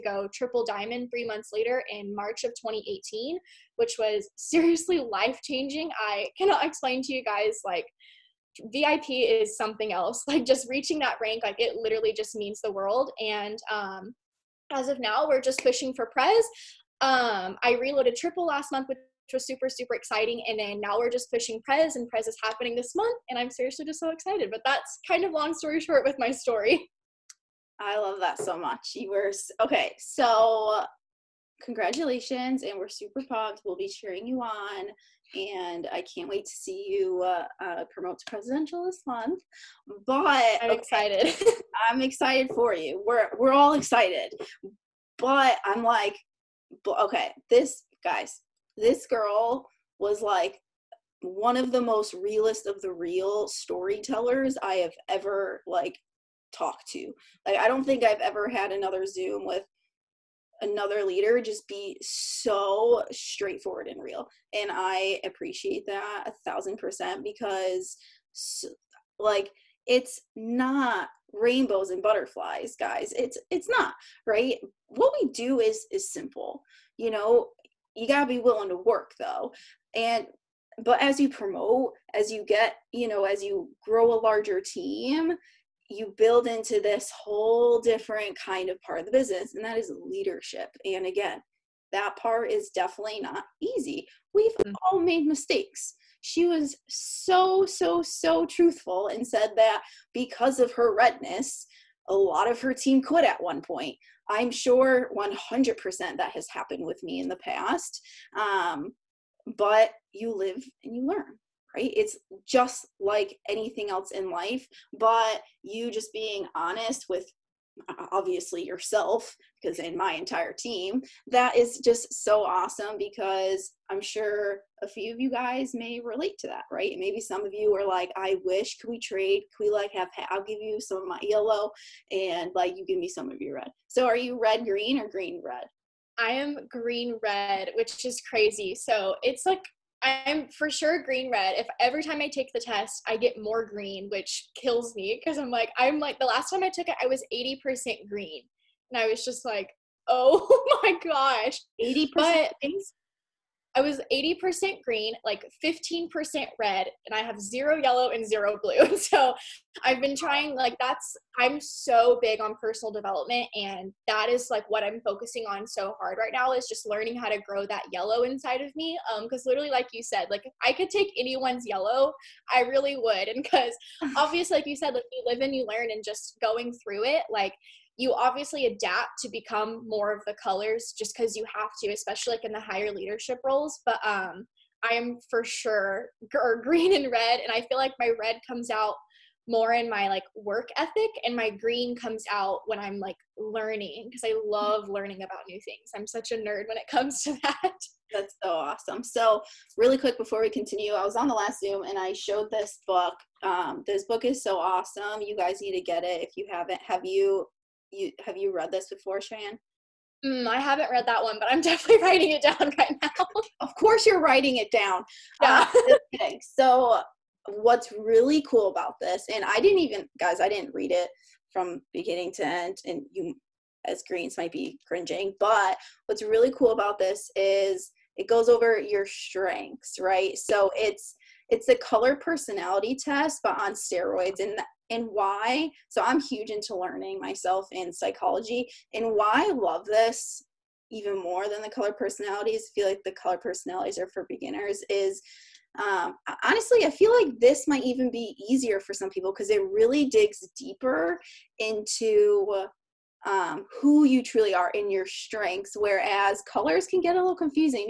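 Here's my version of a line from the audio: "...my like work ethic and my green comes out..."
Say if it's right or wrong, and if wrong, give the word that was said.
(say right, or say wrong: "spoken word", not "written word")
right.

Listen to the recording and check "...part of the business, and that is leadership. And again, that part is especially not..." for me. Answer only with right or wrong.
wrong.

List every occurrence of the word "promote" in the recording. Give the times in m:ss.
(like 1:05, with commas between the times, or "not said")
0:37, 1:21.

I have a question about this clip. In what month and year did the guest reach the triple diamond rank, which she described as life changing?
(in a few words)
March 2018.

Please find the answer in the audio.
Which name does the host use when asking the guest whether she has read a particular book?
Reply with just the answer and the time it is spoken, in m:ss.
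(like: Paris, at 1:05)
Chyann, at 3:29.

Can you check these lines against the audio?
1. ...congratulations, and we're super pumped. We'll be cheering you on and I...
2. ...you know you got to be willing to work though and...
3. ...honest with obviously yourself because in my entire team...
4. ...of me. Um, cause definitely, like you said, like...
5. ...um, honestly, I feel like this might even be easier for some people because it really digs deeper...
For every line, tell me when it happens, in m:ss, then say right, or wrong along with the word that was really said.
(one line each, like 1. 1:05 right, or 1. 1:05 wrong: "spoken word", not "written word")
1. 0:31 right
2. 1:16 right
3. 1:56 right
4. 2:48 wrong: "literally", not "definitely"
5. 4:05 right.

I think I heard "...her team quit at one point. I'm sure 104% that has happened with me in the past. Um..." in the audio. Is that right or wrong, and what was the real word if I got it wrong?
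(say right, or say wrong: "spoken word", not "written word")
wrong: "100", not "104".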